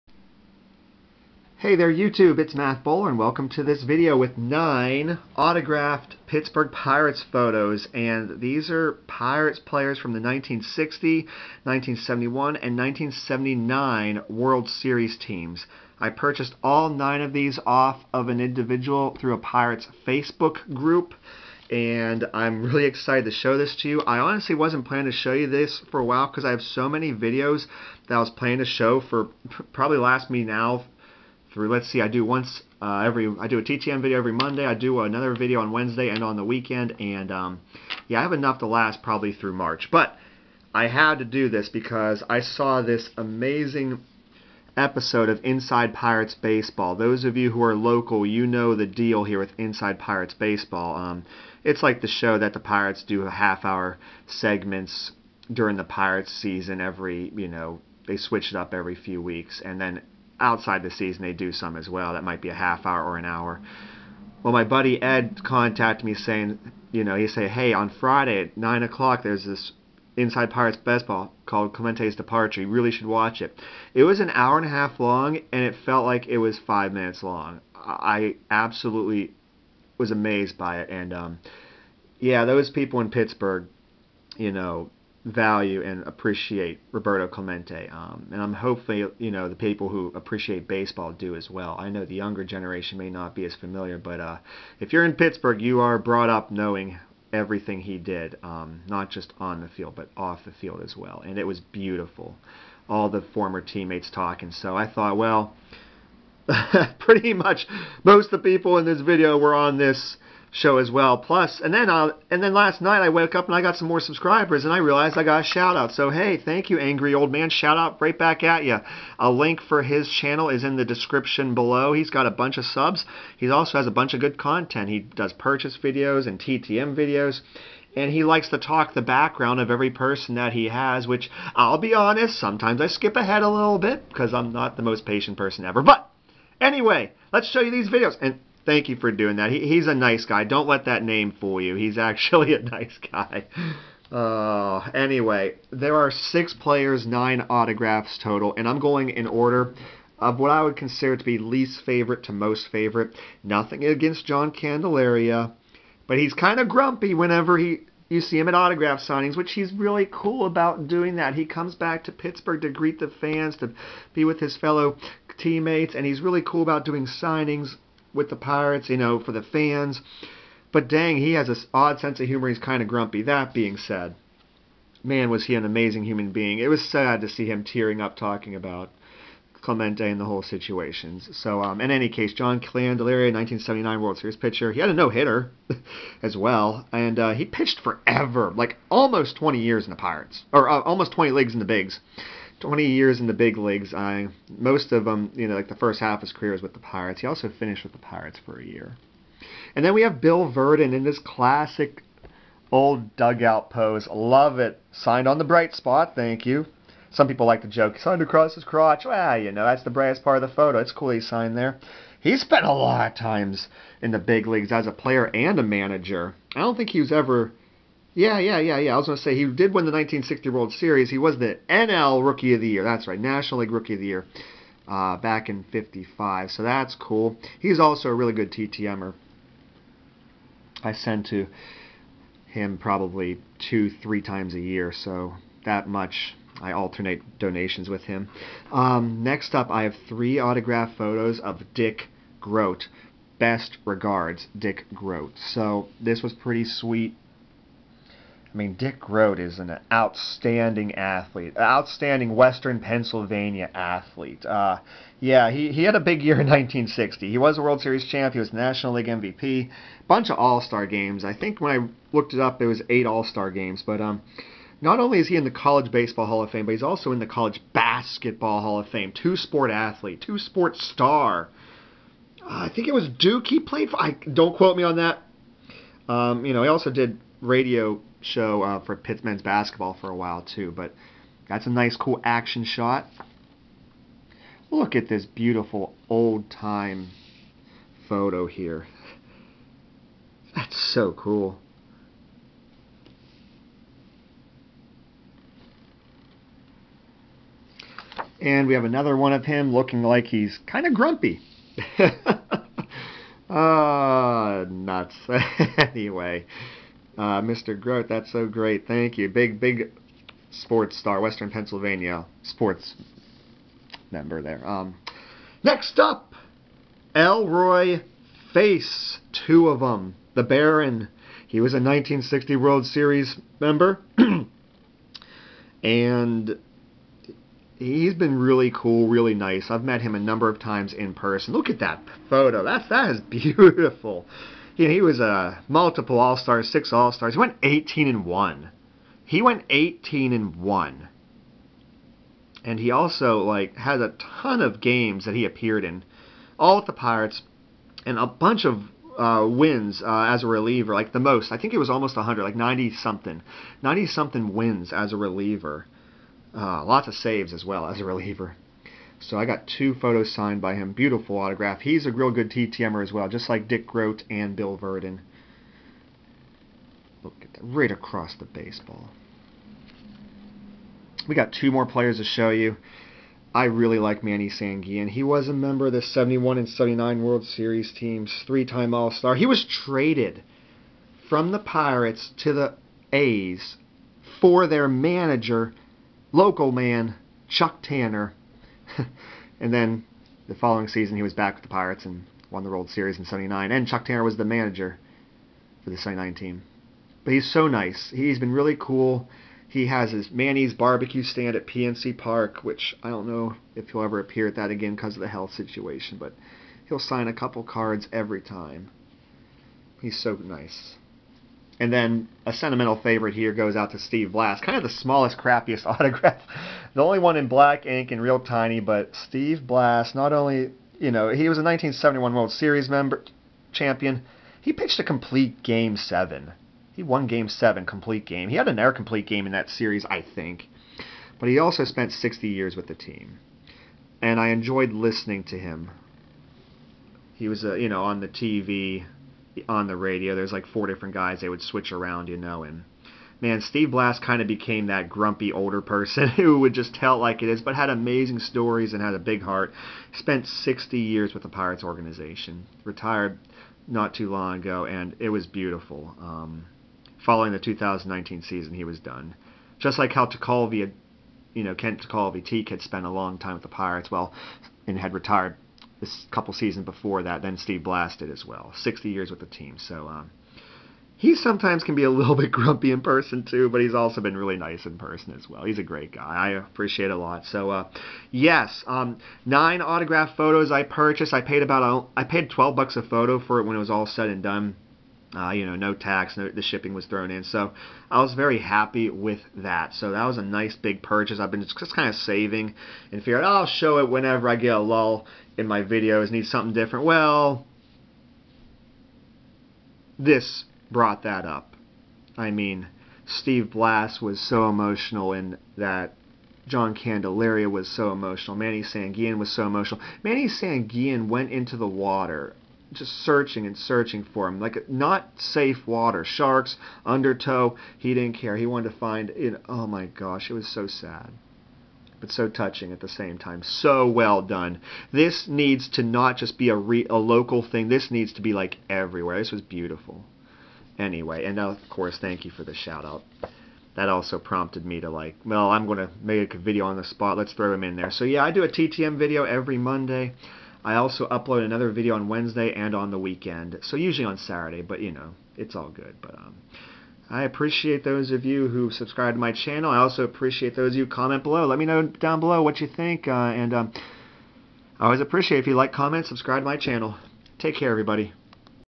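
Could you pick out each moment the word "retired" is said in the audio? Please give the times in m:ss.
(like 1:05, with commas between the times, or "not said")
7:32, 7:45.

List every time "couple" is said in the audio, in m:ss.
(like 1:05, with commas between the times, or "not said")
6:47, 7:46.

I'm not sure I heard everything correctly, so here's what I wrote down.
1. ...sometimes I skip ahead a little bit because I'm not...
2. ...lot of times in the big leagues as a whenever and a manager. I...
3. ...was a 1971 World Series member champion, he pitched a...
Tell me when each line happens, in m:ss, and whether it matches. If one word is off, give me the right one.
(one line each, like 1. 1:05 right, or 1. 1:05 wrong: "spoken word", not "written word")
1. 2:12 right
2. 3:32 wrong: "player", not "whenever"
3. 7:01 right.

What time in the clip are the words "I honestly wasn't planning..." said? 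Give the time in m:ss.
0:24.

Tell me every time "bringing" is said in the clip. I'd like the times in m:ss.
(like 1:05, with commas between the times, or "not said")
not said.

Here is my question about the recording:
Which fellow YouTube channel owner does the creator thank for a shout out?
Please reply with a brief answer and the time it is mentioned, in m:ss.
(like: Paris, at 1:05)
angry old man, at 1:56.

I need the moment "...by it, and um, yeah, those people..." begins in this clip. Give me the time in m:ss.
1:20.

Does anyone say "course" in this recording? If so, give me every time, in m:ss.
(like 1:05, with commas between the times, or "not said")
8:51.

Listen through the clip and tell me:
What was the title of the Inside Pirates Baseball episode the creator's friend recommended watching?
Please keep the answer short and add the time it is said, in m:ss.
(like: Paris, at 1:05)
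Clemente's Departure, at 1:11.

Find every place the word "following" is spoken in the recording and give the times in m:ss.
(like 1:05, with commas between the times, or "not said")
6:30, 7:37.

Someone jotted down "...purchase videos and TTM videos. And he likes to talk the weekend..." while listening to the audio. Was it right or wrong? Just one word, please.
wrong.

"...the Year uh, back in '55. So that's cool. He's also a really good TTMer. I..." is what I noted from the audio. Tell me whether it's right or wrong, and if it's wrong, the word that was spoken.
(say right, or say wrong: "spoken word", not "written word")
right.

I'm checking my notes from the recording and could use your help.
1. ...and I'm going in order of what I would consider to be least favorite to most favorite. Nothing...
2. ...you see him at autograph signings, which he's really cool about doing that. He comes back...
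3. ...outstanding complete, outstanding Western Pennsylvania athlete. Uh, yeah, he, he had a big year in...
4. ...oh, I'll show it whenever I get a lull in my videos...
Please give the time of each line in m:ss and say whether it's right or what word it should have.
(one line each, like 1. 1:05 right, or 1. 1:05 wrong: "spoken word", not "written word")
1. 2:28 right
2. 2:38 right
3. 4:09 wrong: "athlete", not "complete"
4. 8:13 right.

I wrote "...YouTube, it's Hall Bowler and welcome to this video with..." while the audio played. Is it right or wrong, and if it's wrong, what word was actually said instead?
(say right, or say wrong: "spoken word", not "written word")
wrong: "Matt", not "Hall".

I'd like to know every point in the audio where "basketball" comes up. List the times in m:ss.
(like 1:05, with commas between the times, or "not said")
4:27, 4:39.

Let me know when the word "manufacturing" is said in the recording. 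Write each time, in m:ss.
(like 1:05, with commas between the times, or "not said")
not said.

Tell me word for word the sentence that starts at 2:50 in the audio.
But dang, he has this odd sense of humor.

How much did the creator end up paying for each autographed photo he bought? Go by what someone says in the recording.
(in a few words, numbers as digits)
$12.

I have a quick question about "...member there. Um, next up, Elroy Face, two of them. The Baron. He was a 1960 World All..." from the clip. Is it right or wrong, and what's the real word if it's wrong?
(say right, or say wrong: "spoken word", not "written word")
wrong: "Series", not "All".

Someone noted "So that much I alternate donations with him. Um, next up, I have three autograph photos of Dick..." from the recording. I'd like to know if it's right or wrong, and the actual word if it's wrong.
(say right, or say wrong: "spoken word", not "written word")
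right.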